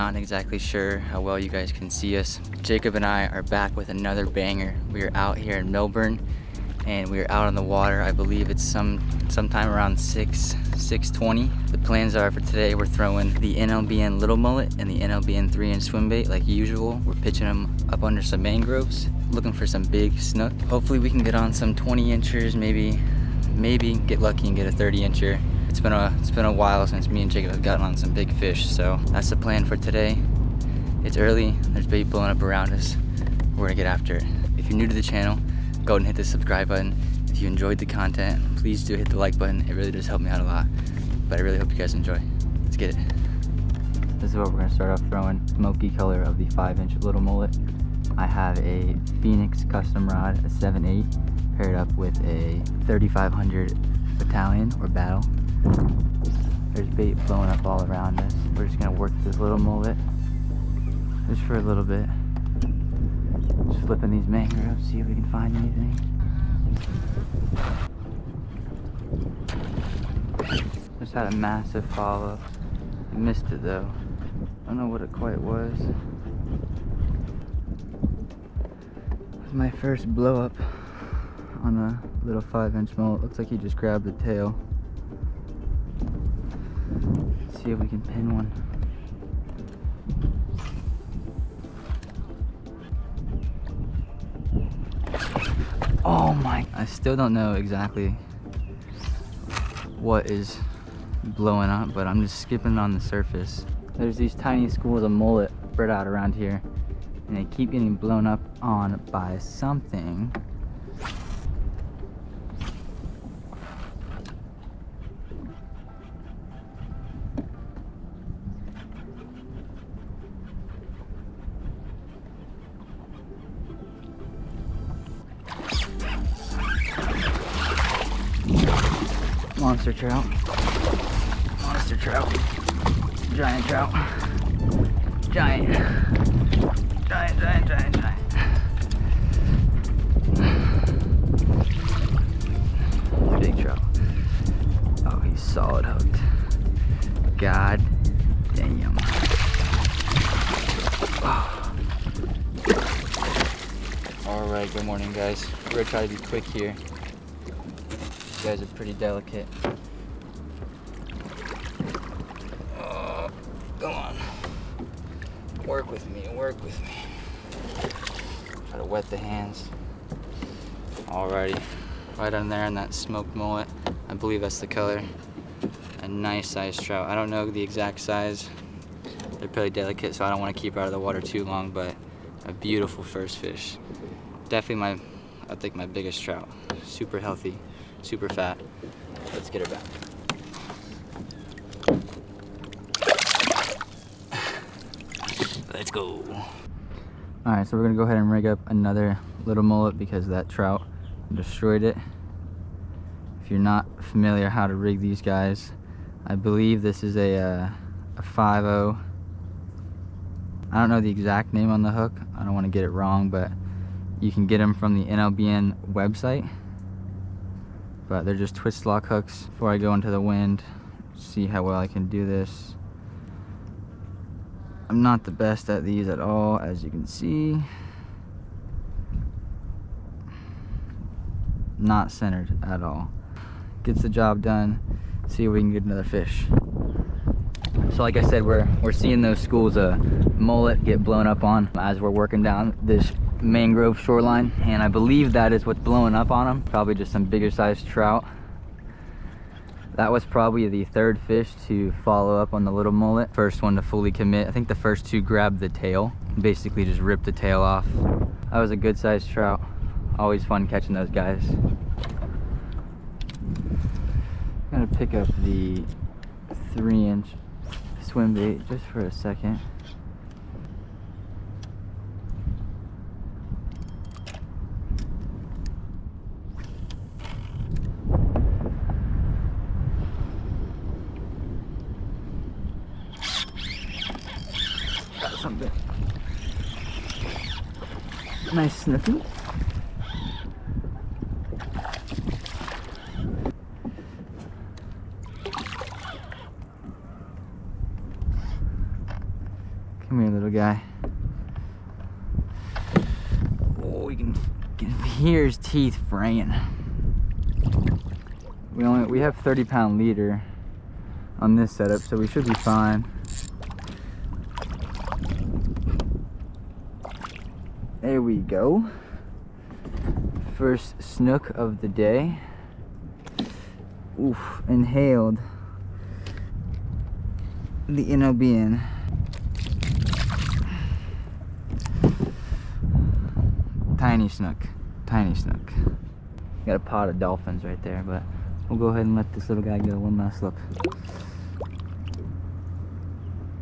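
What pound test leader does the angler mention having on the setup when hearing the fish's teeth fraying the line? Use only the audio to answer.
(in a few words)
30 pound.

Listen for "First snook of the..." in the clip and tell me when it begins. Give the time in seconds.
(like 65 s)
320 s.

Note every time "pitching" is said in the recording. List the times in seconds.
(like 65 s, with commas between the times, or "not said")
17 s.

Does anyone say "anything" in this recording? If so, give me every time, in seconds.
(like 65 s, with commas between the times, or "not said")
65 s.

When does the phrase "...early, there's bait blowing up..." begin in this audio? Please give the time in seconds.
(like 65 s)
31 s.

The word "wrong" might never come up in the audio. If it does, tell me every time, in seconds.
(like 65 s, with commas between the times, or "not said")
212 s.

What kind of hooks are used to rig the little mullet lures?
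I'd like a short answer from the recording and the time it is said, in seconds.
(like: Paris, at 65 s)
twist lock hooks, at 218 s.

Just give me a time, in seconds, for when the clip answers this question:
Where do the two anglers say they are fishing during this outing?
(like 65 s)
5 s.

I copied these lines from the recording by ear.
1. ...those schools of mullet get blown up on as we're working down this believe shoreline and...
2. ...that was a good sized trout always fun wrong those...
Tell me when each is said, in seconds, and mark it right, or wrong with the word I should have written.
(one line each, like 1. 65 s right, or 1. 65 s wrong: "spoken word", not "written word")
1. 239 s wrong: "mangrove", not "believe"
2. 258 s wrong: "catching", not "wrong".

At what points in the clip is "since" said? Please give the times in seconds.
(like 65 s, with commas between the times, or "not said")
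26 s.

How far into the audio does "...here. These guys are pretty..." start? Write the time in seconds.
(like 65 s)
156 s.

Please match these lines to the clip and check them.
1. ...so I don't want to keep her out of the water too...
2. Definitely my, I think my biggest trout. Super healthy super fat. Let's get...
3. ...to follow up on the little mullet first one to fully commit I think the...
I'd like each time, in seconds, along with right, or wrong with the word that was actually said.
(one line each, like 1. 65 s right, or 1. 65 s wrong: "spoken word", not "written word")
1. 180 s right
2. 184 s right
3. 251 s right.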